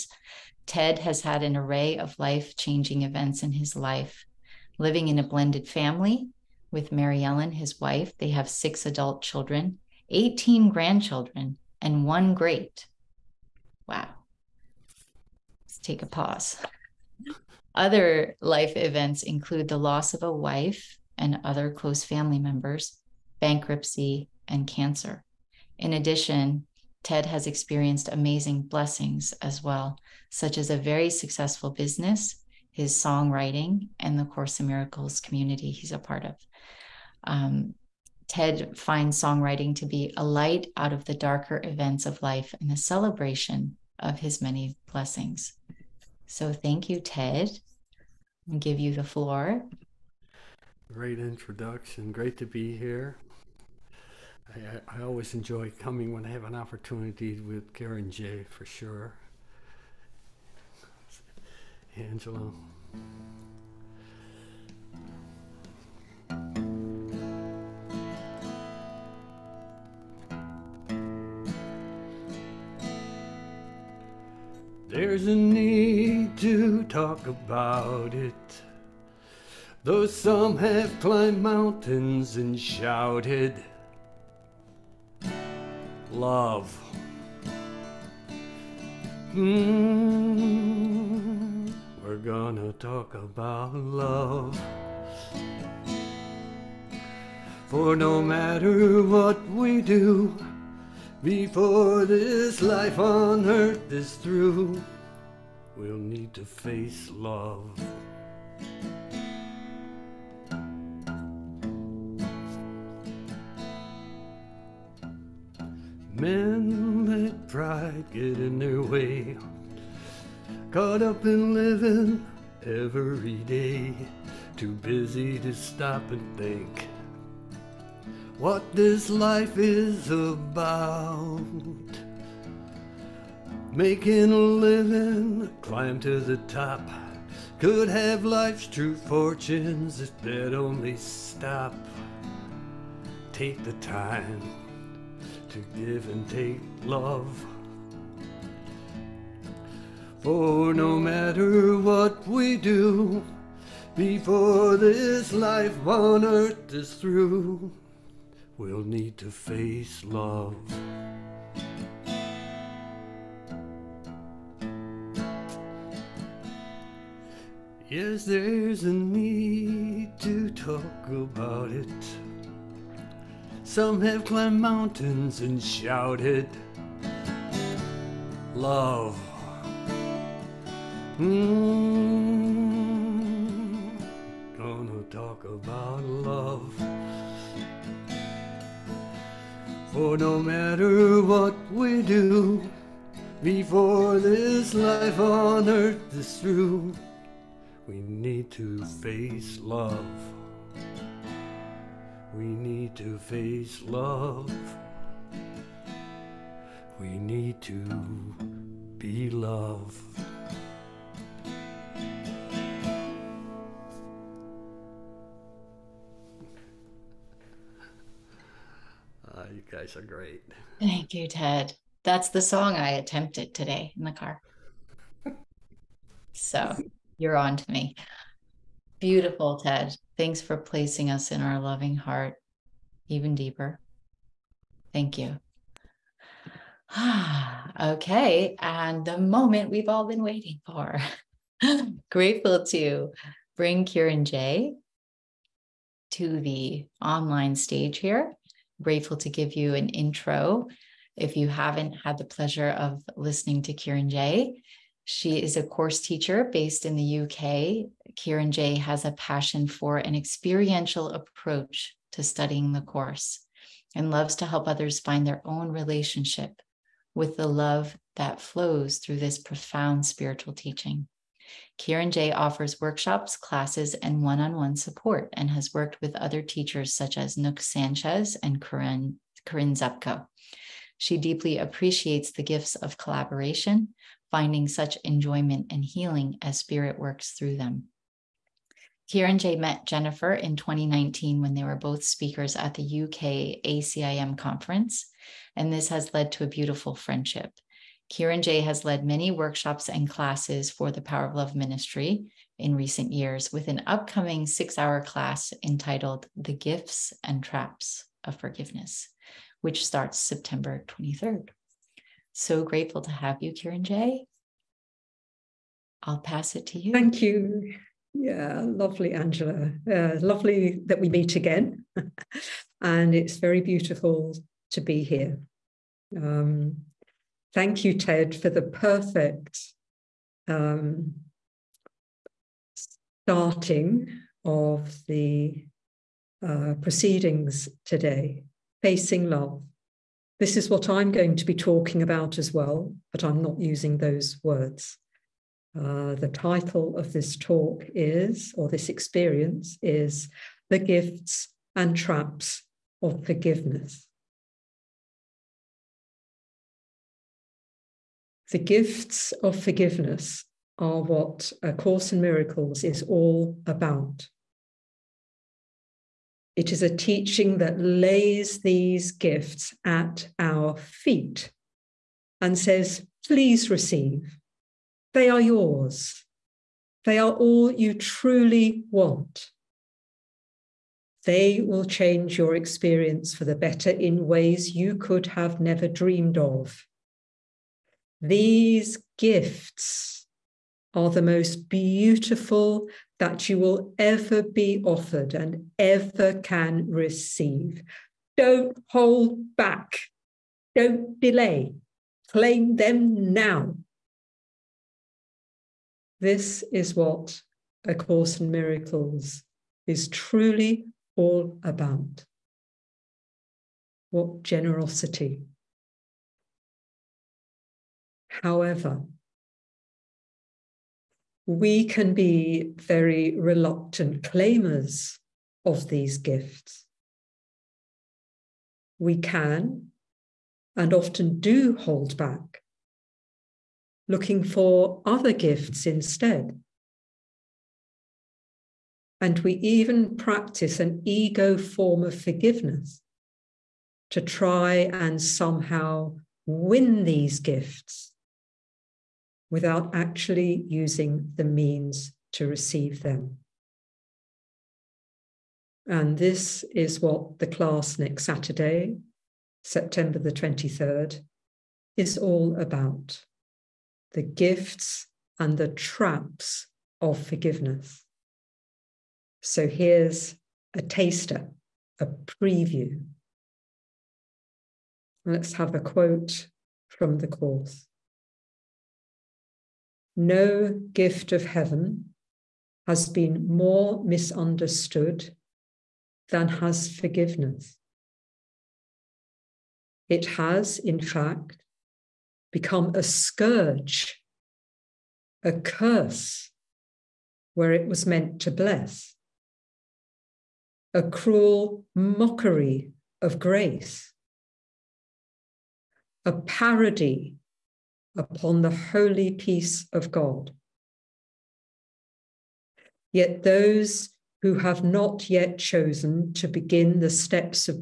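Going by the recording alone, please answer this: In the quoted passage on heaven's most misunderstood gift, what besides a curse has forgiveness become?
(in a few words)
A scourge.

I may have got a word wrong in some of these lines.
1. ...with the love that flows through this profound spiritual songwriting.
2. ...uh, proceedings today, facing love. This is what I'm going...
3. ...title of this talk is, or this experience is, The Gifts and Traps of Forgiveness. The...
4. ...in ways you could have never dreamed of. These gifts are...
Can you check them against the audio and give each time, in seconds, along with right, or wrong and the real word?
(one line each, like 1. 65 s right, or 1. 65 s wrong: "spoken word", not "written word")
1. 267 s wrong: "teaching", not "songwriting"
2. 336 s right
3. 346 s right
4. 383 s right.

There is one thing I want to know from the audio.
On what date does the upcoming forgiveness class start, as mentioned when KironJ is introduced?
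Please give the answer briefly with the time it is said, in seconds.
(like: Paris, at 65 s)
September 23rd, at 310 s.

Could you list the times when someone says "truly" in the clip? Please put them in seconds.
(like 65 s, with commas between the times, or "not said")
377 s, 410 s.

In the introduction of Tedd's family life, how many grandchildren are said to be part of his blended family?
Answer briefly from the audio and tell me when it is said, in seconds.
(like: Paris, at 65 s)
18, at 10 s.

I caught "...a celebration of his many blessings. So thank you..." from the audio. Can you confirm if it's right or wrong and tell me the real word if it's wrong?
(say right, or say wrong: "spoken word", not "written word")
right.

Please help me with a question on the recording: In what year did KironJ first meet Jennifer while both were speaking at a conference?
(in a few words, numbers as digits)
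2019.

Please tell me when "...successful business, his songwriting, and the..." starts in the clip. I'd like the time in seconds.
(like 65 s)
31 s.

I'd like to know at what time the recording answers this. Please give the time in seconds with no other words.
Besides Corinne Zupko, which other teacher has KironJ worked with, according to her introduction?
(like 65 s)
277 s.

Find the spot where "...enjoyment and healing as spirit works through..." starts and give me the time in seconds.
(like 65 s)
285 s.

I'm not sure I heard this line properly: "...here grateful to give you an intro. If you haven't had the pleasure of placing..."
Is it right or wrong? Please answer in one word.
wrong.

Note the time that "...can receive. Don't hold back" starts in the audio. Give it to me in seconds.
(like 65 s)
396 s.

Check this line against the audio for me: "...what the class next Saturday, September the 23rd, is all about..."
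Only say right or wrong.
right.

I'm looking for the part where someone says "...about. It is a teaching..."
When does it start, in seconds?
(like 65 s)
363 s.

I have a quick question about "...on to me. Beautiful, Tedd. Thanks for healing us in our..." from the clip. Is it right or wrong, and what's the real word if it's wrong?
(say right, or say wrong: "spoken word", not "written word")
wrong: "placing", not "healing".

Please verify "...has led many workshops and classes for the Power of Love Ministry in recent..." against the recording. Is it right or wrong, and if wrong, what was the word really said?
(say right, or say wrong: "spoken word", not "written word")
right.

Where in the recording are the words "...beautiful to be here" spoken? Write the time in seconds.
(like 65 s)
323 s.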